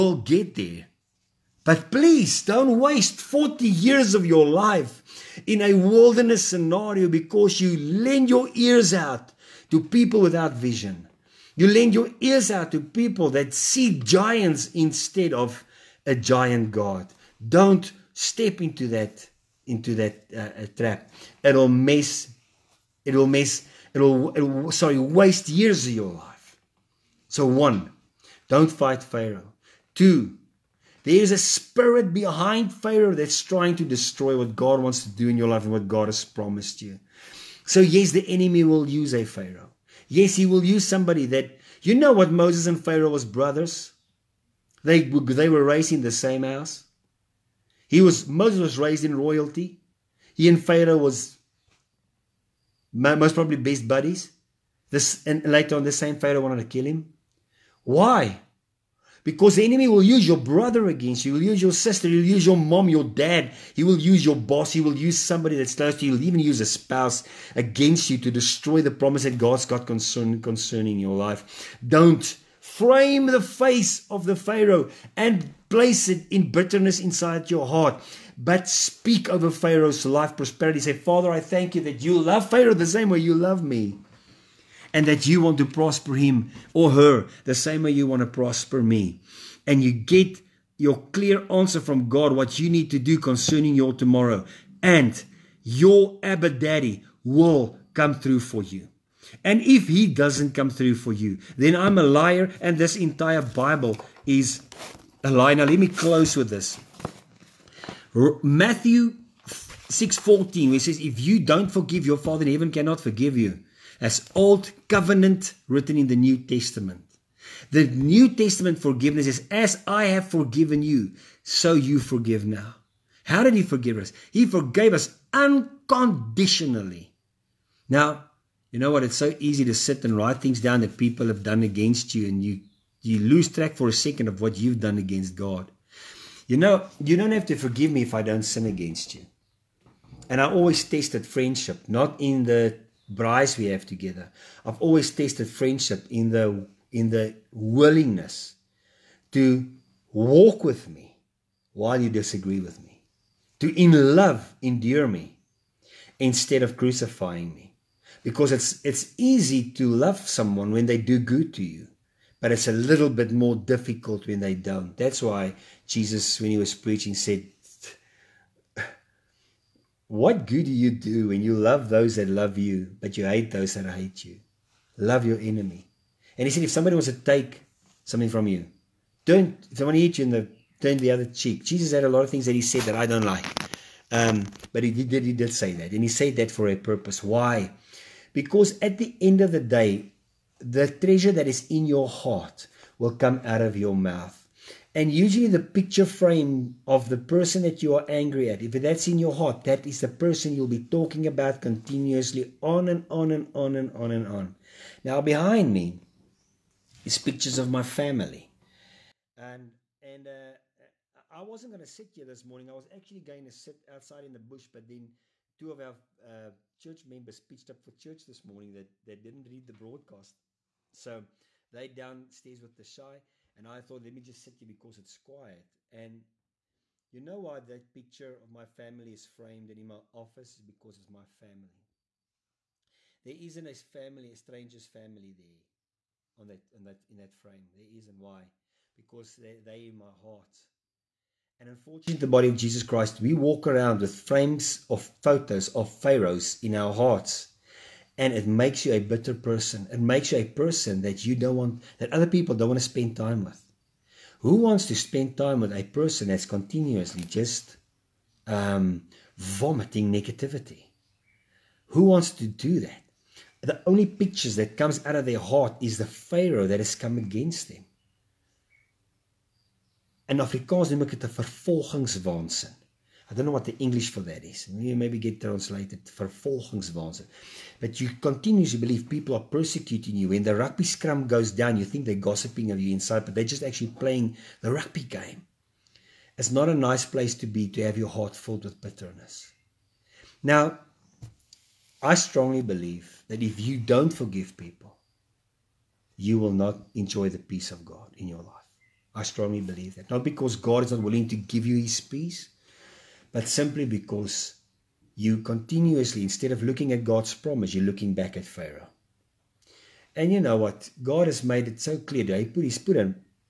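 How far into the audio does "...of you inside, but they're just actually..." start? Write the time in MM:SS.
04:42.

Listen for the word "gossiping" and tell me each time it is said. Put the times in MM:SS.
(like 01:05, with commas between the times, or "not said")
04:42.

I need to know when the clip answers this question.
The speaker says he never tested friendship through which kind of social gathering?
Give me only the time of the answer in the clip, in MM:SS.
02:23.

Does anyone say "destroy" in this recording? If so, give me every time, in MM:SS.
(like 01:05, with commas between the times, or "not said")
00:33, 01:08.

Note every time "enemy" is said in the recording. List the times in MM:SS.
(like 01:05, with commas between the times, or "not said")
00:38, 00:59, 02:55.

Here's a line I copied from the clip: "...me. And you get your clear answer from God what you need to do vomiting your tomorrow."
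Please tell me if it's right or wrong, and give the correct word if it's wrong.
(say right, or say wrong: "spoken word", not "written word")
wrong: "concerning", not "vomiting".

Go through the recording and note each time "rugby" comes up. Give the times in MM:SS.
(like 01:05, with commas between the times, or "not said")
04:40, 04:44.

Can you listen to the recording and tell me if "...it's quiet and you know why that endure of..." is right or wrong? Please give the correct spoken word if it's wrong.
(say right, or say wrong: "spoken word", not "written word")
wrong: "picture", not "endure".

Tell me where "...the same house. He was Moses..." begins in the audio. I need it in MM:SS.
00:46.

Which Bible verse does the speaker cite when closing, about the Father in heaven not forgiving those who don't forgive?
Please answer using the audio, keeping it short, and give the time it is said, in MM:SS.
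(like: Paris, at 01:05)
Matthew 6:14, at 01:48.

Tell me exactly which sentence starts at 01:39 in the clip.
And if he doesn't come through for you, then I'm a liar, and this entire Bible is a lie.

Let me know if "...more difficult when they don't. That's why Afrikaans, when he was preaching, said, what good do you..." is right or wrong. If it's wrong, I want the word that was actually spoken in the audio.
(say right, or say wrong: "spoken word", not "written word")
wrong: "Jesus", not "Afrikaans".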